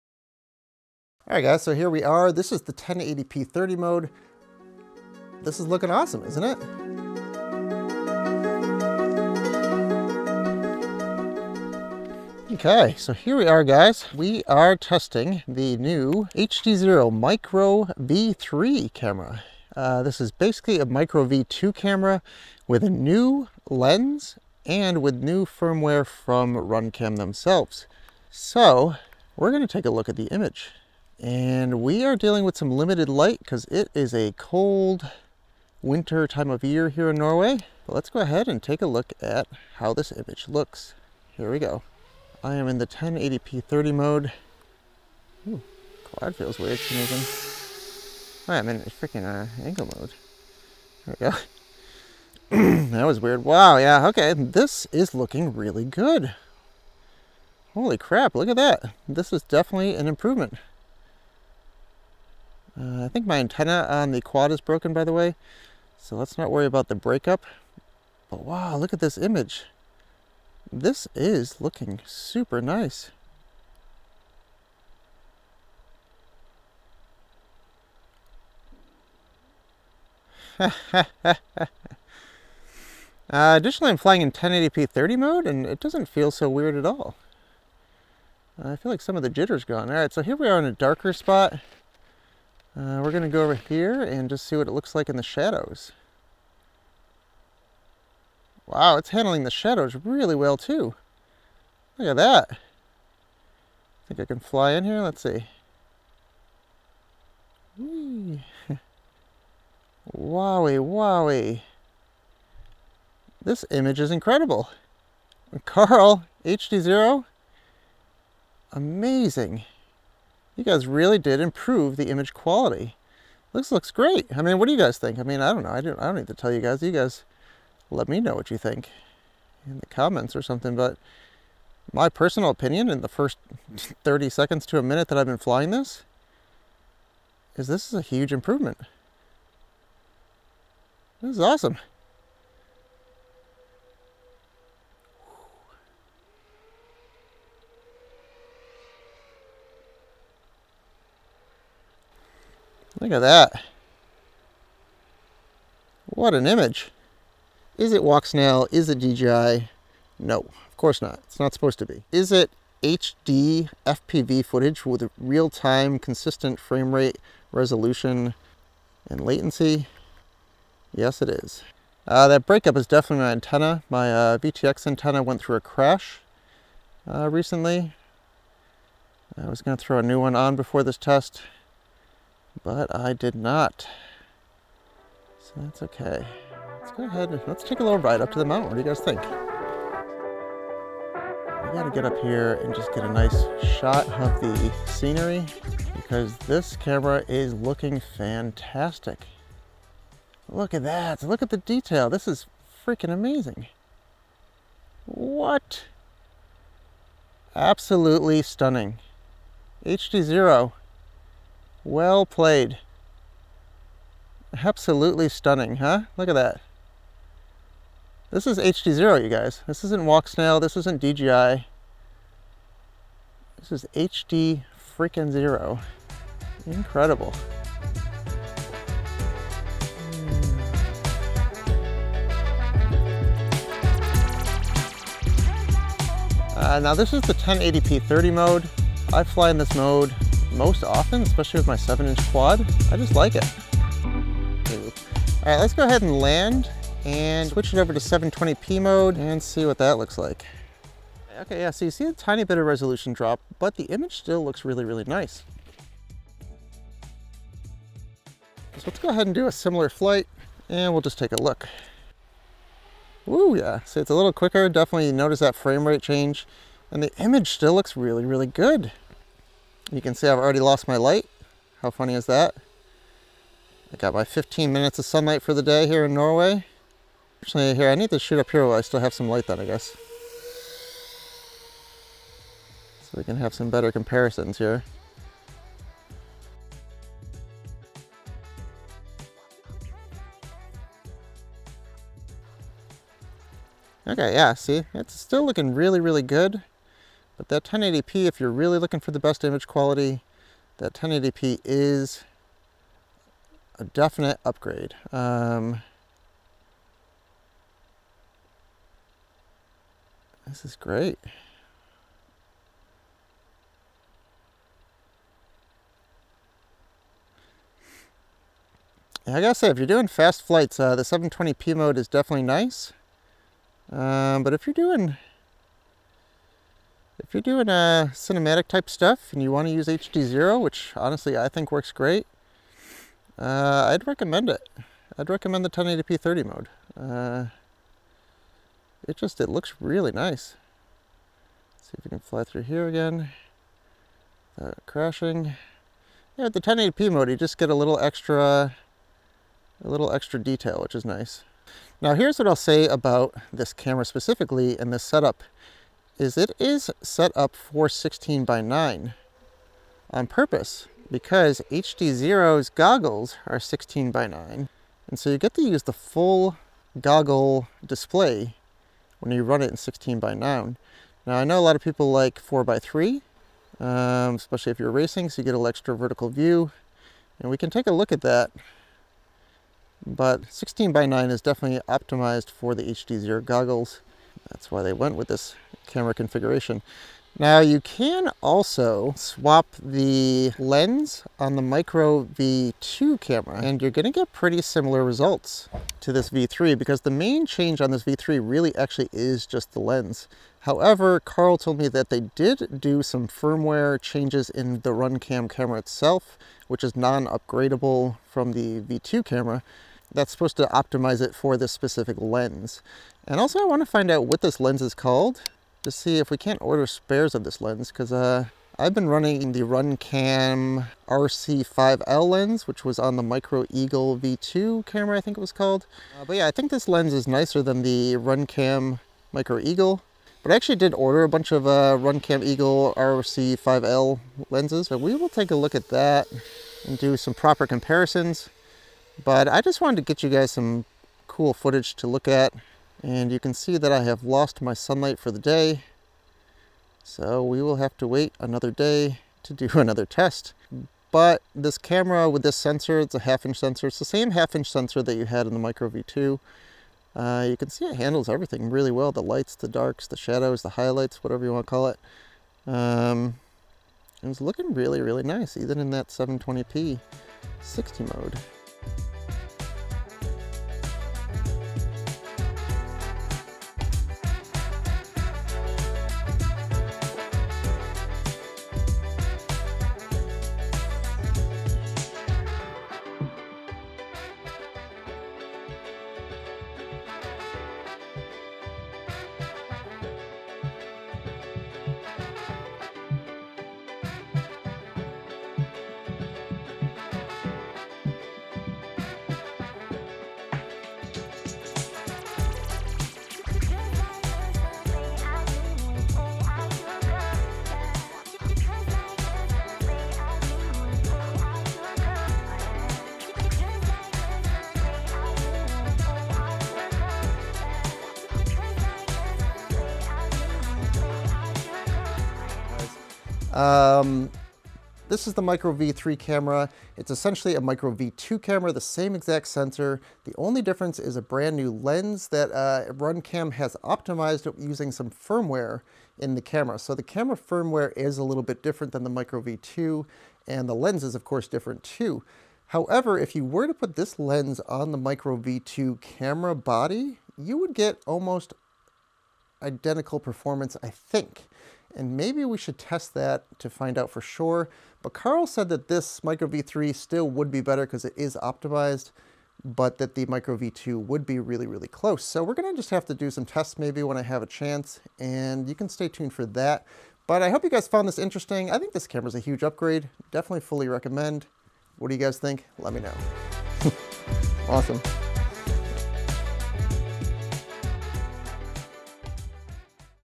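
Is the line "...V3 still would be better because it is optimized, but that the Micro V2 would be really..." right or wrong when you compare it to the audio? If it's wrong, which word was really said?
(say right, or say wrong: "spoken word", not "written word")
right.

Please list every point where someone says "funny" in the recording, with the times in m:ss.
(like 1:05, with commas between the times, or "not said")
4:31.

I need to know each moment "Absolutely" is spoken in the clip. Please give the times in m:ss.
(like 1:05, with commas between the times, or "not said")
3:27, 3:34.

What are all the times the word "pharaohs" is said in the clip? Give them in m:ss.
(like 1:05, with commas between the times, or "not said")
not said.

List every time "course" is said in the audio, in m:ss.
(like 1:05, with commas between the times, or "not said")
2:40, 9:01.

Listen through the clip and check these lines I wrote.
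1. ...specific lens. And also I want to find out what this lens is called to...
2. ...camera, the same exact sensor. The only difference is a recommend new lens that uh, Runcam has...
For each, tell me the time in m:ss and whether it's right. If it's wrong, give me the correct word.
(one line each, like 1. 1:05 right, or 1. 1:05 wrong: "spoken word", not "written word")
1. 6:51 right
2. 8:48 wrong: "brand", not "recommend".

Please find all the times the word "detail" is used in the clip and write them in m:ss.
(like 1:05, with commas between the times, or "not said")
3:21, 5:50.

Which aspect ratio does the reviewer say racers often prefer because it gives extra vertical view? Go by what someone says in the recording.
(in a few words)
4 by 3.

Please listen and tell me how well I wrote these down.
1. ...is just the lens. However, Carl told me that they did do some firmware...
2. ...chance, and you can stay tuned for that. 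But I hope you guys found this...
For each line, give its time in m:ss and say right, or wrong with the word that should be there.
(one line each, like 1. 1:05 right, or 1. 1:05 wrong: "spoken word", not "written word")
1. 6:39 right
2. 9:24 right.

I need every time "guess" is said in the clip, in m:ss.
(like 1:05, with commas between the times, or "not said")
4:39.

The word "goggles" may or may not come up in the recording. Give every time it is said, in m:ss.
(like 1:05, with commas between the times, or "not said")
6:02, 6:07, 6:23.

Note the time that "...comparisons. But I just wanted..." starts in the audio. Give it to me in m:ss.
7:17.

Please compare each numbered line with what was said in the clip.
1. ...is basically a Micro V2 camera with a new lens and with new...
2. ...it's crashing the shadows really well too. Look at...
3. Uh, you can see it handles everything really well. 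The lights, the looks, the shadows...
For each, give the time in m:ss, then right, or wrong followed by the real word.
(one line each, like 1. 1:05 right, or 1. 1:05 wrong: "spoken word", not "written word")
1. 0:20 right
2. 1:38 wrong: "handling", not "crashing"
3. 7:37 wrong: "darks", not "looks".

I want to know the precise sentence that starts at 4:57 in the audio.
But that 1080p, if you're really looking for the best image quality, that 1080p is a definite upgrade.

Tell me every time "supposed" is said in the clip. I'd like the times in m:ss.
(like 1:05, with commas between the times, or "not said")
2:41, 6:50.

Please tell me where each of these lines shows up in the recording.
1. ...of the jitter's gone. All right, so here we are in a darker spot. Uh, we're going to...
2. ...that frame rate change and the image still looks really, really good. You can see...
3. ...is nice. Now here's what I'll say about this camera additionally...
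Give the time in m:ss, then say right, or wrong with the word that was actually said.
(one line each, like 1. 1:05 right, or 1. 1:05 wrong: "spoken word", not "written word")
1. 1:29 right
2. 4:25 right
3. 5:50 wrong: "specifically", not "additionally".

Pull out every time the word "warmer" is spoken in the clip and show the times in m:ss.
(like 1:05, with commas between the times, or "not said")
not said.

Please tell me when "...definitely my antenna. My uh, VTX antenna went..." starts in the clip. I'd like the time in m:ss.
2:52.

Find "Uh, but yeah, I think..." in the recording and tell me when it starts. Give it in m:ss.
7:06.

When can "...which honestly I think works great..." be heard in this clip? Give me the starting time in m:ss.
5:30.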